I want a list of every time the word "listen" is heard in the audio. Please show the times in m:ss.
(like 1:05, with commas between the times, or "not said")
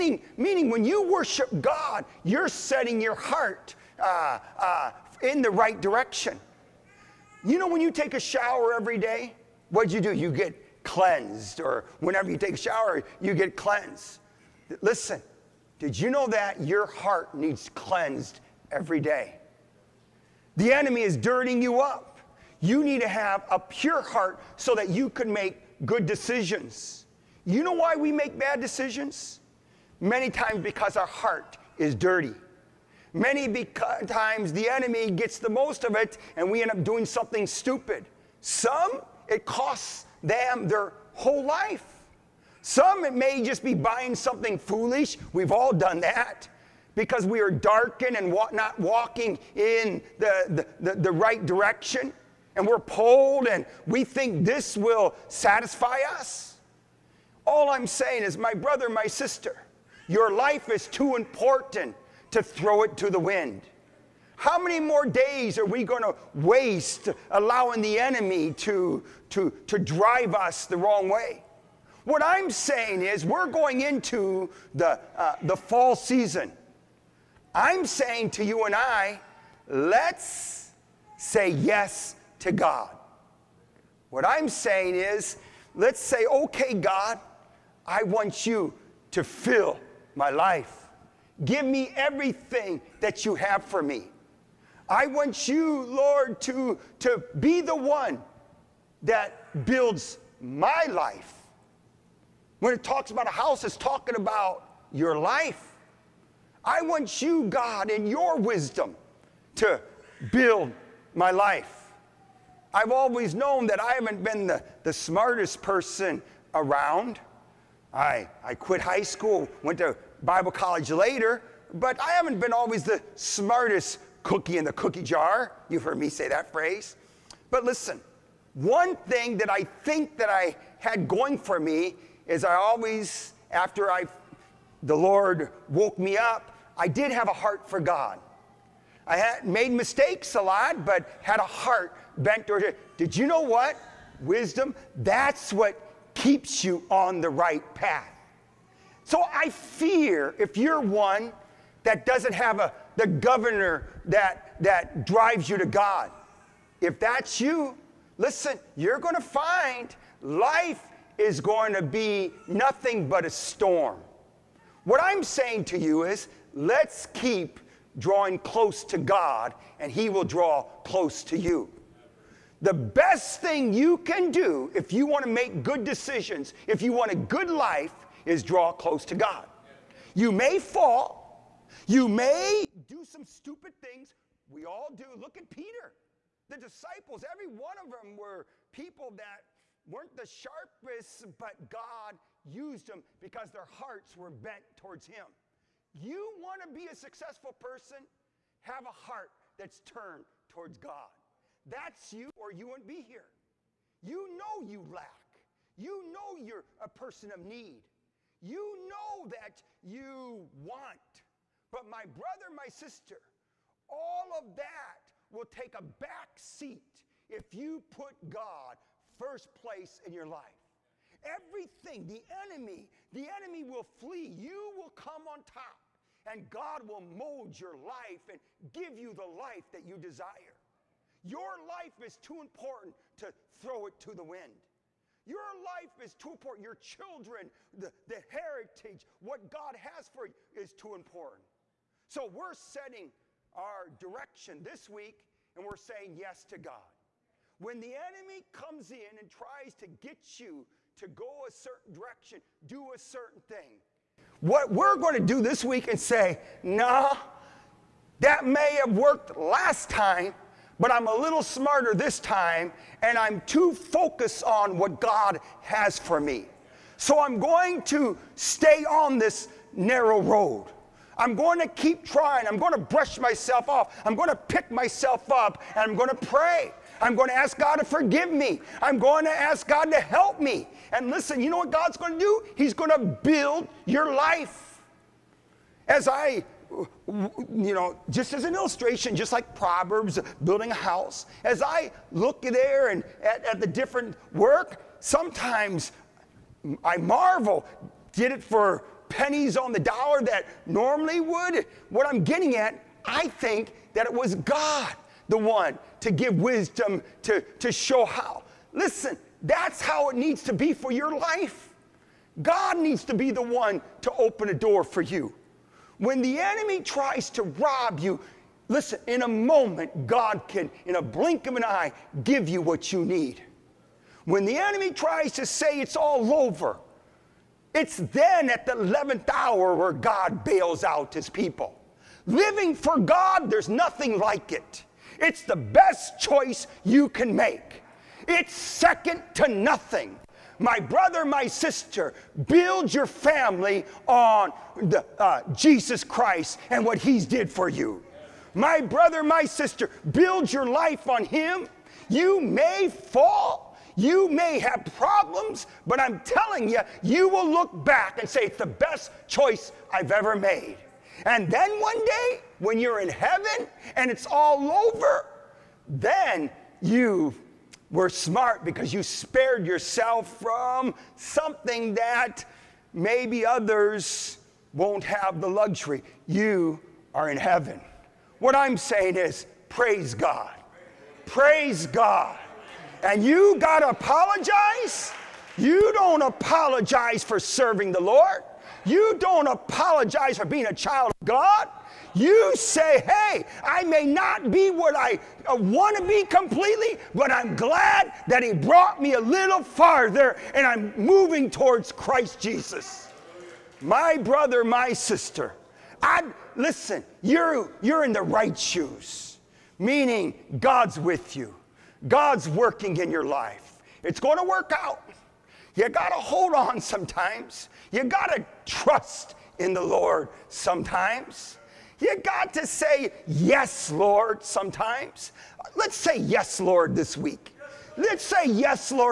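0:14, 2:07, 2:38, 4:41, 5:08, 5:18, 6:46.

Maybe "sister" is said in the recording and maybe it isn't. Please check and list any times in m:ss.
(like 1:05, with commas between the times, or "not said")
0:59, 3:32, 5:41, 5:49, 6:44.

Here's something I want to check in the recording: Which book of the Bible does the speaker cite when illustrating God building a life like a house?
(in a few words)
Proverbs.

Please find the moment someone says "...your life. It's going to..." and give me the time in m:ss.
6:53.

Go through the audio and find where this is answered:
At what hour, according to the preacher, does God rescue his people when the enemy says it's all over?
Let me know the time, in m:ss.
5:28.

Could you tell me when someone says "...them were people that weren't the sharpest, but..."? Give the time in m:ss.
3:07.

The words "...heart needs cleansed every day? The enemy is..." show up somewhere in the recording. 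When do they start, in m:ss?
0:16.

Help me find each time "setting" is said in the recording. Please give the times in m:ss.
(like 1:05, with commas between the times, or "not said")
0:02, 4:02.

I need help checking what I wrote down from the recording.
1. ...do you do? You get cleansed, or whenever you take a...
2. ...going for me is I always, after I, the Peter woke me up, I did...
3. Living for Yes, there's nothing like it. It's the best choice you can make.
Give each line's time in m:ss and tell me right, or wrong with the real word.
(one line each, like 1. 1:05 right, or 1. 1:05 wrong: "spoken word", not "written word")
1. 0:09 right
2. 2:11 wrong: "Lord", not "Peter"
3. 5:32 wrong: "God", not "Yes".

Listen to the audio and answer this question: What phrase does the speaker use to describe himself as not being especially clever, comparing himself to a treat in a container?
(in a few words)
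Smartest cookie in the cookie jar.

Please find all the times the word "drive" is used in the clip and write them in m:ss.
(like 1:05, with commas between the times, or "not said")
1:09, 2:35.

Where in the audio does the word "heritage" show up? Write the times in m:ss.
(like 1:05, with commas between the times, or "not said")
3:58.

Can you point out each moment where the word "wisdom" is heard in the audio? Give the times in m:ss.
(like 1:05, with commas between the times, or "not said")
1:48, 2:24, 5:06.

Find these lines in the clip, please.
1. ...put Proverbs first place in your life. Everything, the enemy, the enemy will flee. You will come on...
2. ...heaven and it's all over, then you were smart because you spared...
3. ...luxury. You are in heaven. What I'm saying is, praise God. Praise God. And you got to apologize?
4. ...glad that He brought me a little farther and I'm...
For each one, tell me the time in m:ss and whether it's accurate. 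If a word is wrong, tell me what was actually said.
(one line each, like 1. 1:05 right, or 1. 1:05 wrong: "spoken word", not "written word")
1. 3:37 wrong: "God", not "Proverbs"
2. 6:03 right
3. 6:15 right
4. 6:37 right.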